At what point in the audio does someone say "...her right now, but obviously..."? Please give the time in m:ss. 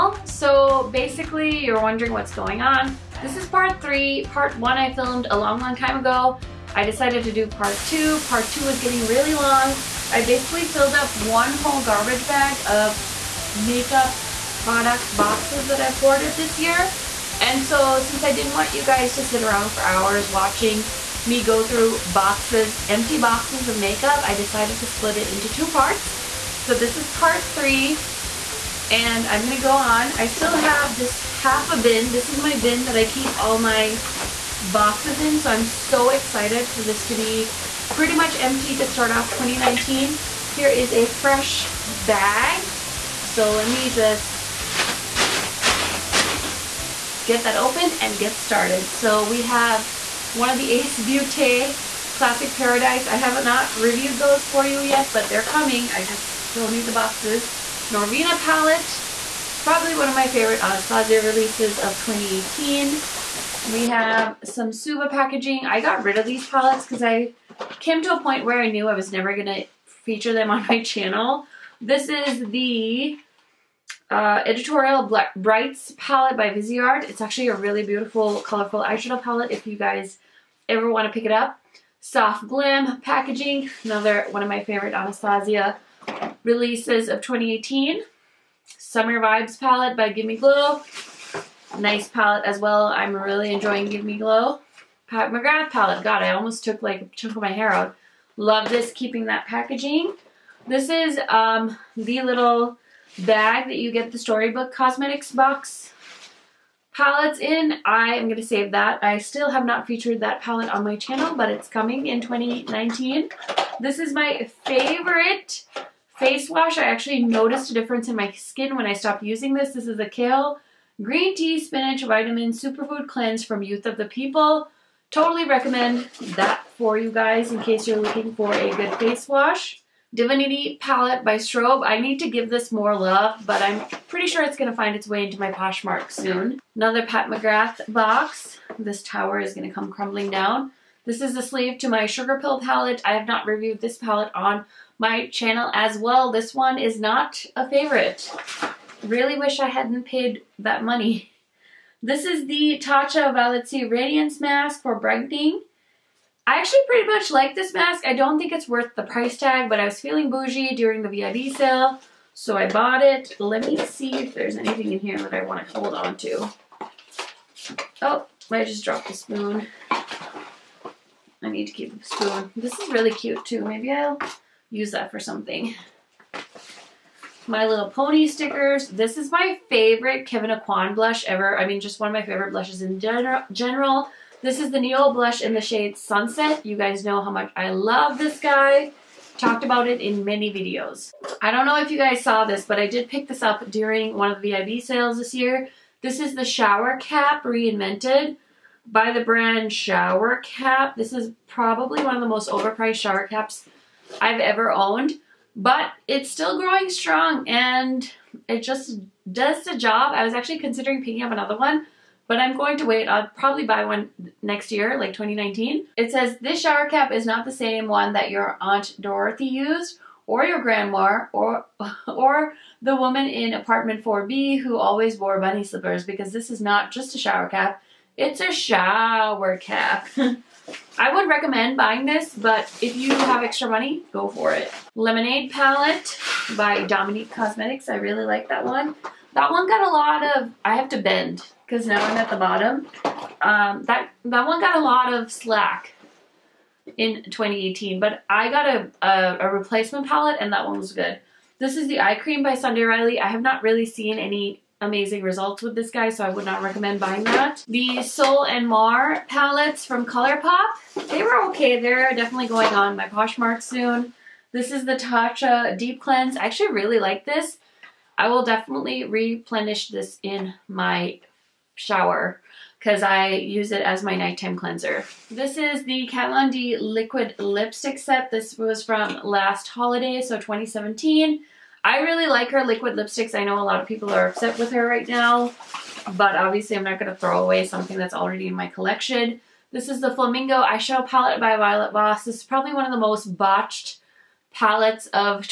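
4:44.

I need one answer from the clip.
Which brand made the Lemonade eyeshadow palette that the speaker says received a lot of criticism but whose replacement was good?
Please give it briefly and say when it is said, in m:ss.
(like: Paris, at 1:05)
Dominique Cosmetics, at 3:56.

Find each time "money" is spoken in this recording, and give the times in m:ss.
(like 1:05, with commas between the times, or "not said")
2:30, 3:53.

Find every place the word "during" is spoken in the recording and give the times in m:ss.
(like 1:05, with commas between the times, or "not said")
2:40, 3:13.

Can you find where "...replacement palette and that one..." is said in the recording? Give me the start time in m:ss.
4:09.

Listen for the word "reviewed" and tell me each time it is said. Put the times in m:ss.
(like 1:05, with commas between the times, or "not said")
0:53, 2:23.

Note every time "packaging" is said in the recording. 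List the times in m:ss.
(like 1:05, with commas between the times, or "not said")
1:05, 1:22, 1:39.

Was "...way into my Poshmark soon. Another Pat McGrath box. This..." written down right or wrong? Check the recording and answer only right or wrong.
right.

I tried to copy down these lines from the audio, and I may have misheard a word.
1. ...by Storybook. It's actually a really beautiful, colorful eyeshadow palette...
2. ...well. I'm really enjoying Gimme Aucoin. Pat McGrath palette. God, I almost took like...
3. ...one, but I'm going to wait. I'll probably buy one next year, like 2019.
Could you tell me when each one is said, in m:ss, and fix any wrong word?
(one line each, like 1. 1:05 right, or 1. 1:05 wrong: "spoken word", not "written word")
1. 1:16 wrong: "Viseart", not "Storybook"
2. 1:32 wrong: "Glow", not "Aucoin"
3. 3:31 right.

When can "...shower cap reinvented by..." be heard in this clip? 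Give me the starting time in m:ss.
3:16.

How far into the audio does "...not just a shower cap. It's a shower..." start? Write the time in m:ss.
3:46.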